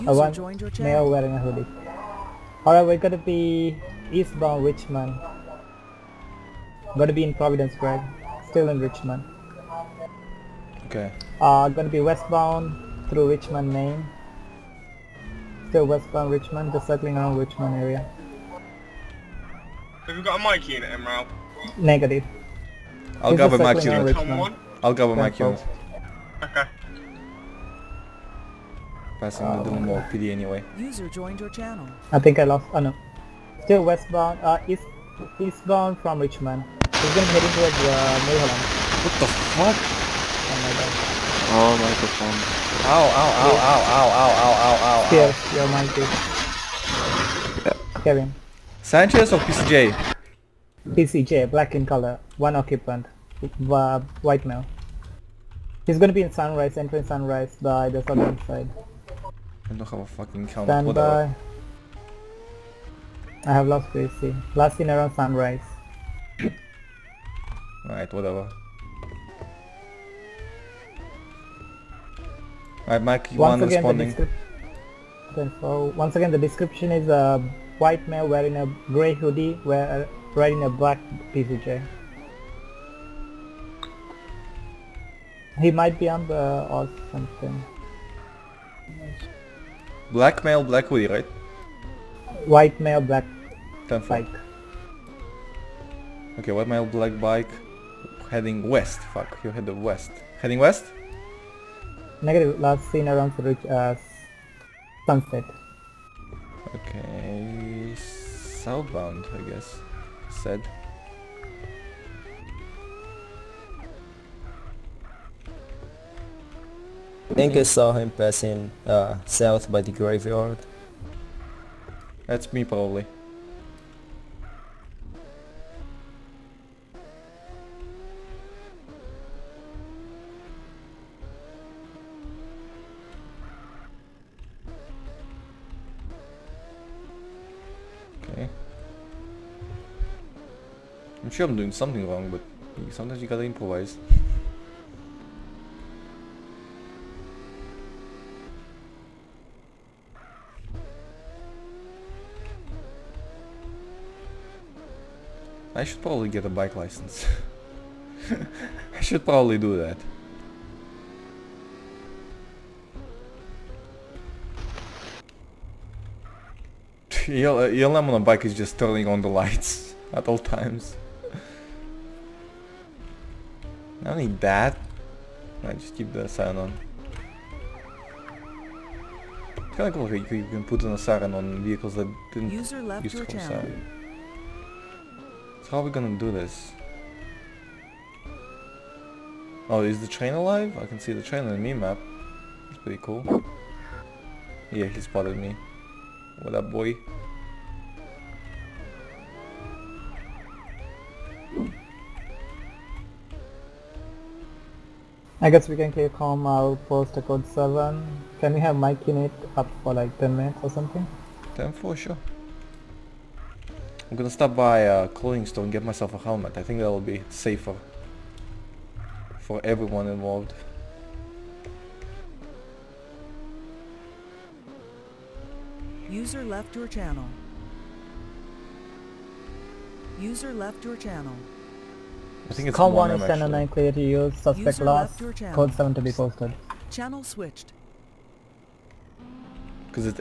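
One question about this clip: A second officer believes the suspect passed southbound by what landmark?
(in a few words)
the graveyard.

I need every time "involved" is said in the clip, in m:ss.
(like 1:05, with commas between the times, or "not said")
3:40.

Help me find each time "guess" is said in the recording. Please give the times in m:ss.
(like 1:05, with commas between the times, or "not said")
1:49, 3:25.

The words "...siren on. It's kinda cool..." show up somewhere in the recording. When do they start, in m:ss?
2:56.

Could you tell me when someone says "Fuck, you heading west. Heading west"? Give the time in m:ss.
1:39.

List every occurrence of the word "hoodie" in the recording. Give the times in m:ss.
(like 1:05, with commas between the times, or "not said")
0:01, 1:19, 1:30.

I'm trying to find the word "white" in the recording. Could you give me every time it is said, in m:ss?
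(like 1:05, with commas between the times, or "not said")
0:53, 1:17, 1:32, 1:36.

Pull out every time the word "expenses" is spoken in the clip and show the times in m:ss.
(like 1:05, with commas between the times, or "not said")
not said.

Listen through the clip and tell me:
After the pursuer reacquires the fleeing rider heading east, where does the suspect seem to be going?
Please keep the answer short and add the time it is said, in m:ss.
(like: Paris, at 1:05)
Maryland, at 0:38.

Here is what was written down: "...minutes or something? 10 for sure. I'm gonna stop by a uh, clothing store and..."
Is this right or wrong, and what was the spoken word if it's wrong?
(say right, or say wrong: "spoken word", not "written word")
right.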